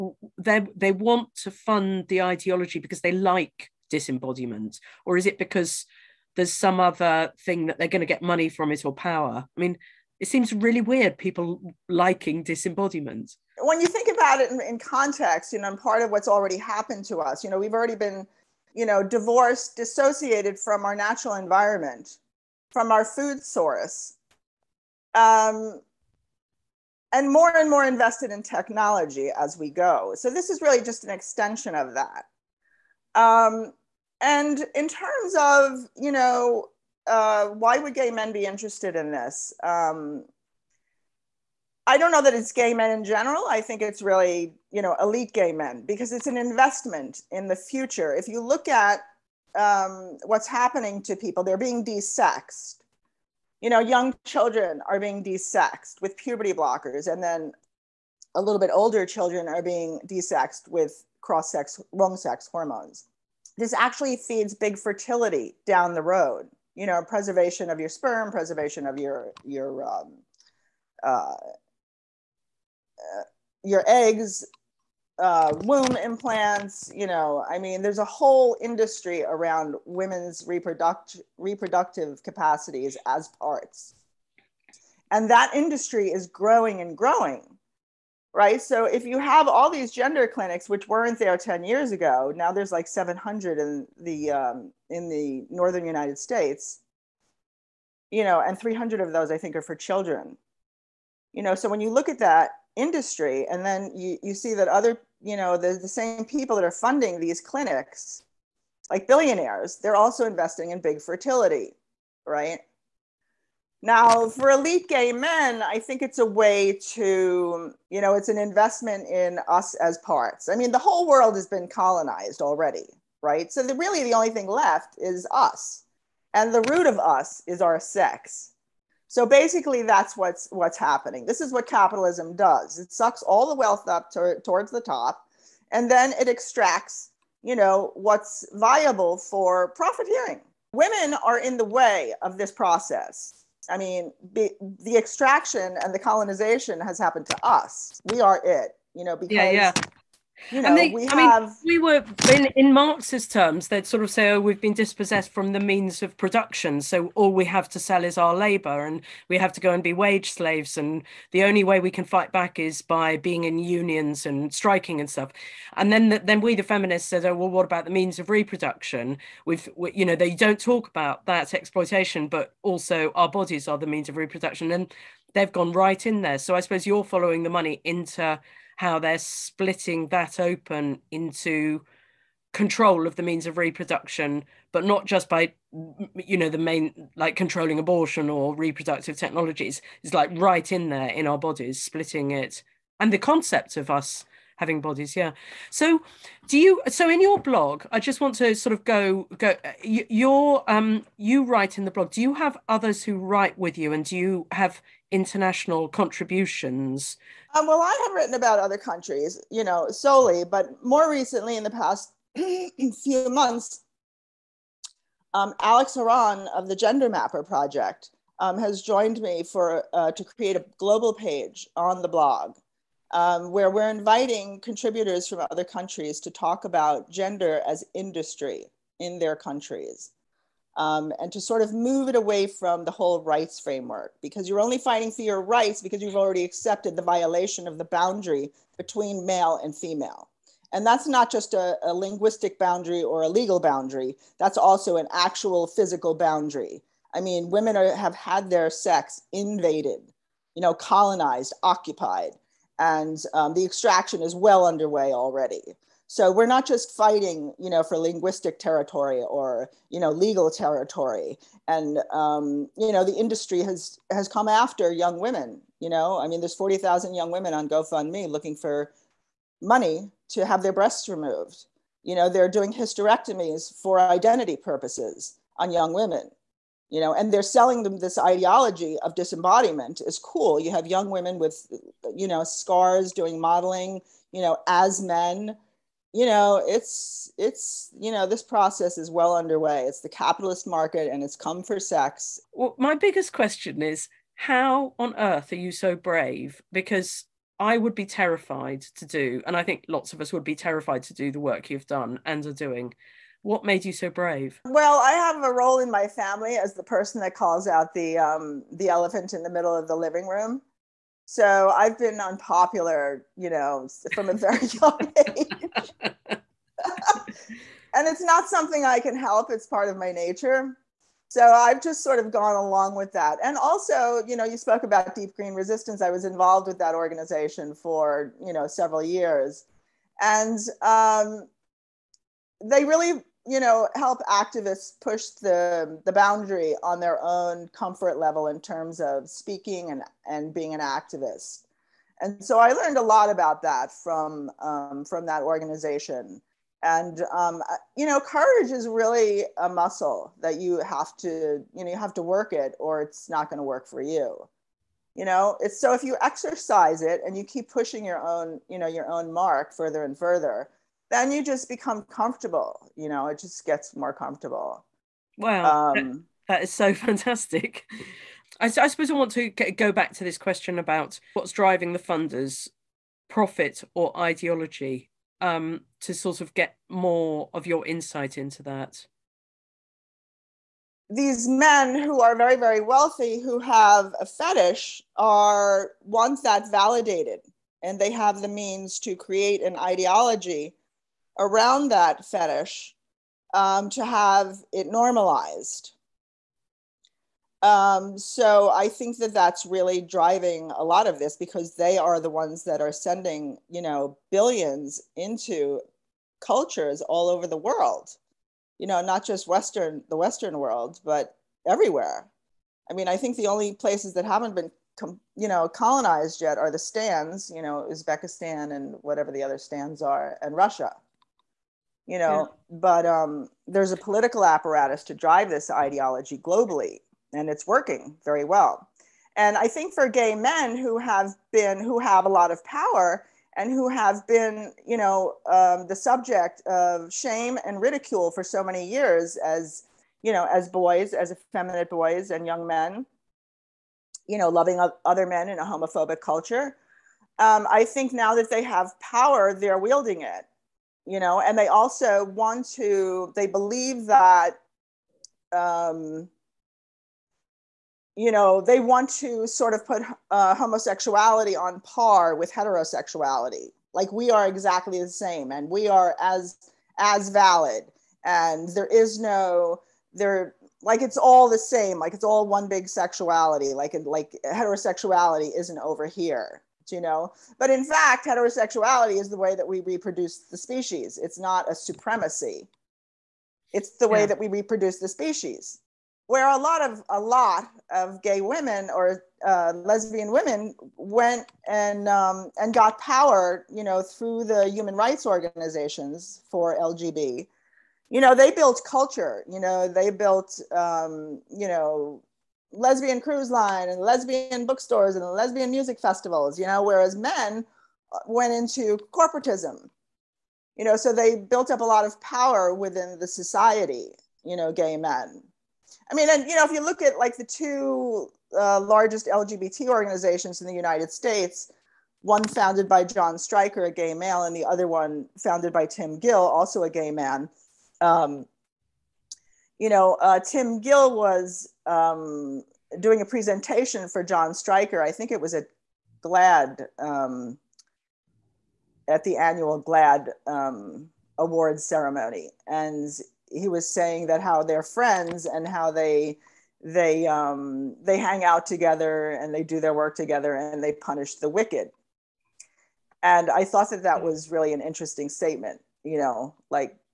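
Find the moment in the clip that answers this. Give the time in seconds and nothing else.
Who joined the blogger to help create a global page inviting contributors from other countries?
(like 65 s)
215 s.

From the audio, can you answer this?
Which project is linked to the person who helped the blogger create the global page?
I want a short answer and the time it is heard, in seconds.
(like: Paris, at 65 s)
Gender Mapper Project, at 216 s.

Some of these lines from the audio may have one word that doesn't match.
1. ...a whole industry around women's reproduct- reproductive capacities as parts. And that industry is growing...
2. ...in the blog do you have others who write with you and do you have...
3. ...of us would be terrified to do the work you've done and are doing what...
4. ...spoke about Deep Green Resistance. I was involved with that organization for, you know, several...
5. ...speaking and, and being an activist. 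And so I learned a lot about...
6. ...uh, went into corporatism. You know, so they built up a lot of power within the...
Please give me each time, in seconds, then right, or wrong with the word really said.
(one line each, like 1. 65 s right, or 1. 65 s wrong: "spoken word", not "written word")
1. 77 s right
2. 201 s right
3. 300 s right
4. 324 s right
5. 339 s right
6. 508 s right.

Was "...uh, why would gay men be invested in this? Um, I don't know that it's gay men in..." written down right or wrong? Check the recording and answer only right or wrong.
wrong.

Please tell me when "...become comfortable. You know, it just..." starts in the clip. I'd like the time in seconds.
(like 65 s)
361 s.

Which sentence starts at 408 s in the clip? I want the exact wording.
You know, not just Western, the Western world, but everywhere.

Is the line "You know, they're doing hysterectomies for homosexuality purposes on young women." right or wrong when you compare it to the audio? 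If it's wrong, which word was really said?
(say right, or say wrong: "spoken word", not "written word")
wrong: "identity", not "homosexuality".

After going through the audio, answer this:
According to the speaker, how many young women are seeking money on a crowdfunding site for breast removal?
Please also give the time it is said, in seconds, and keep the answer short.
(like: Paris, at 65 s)
40,000, at 266 s.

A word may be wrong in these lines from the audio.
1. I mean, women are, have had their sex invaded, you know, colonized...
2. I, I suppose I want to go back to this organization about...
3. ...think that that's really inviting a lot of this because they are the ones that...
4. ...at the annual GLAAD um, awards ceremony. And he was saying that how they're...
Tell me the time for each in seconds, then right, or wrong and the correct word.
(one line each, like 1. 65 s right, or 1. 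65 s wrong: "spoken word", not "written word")
1. 247 s right
2. 368 s wrong: "question", not "organization"
3. 398 s wrong: "driving", not "inviting"
4. 539 s right.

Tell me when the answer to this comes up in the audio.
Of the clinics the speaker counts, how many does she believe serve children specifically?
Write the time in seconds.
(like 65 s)
98 s.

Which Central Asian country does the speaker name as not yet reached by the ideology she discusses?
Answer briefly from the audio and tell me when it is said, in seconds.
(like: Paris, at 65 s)
Uzbekistan, at 417 s.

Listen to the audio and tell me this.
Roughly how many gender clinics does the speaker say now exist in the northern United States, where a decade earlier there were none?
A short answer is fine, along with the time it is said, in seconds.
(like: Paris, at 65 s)
700, at 92 s.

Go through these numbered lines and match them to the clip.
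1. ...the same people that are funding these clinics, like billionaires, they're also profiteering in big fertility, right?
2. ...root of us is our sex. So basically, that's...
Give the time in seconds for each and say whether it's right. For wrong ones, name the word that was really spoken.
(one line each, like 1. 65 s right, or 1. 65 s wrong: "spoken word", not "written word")
1. 105 s wrong: "investing", not "profiteering"
2. 126 s right.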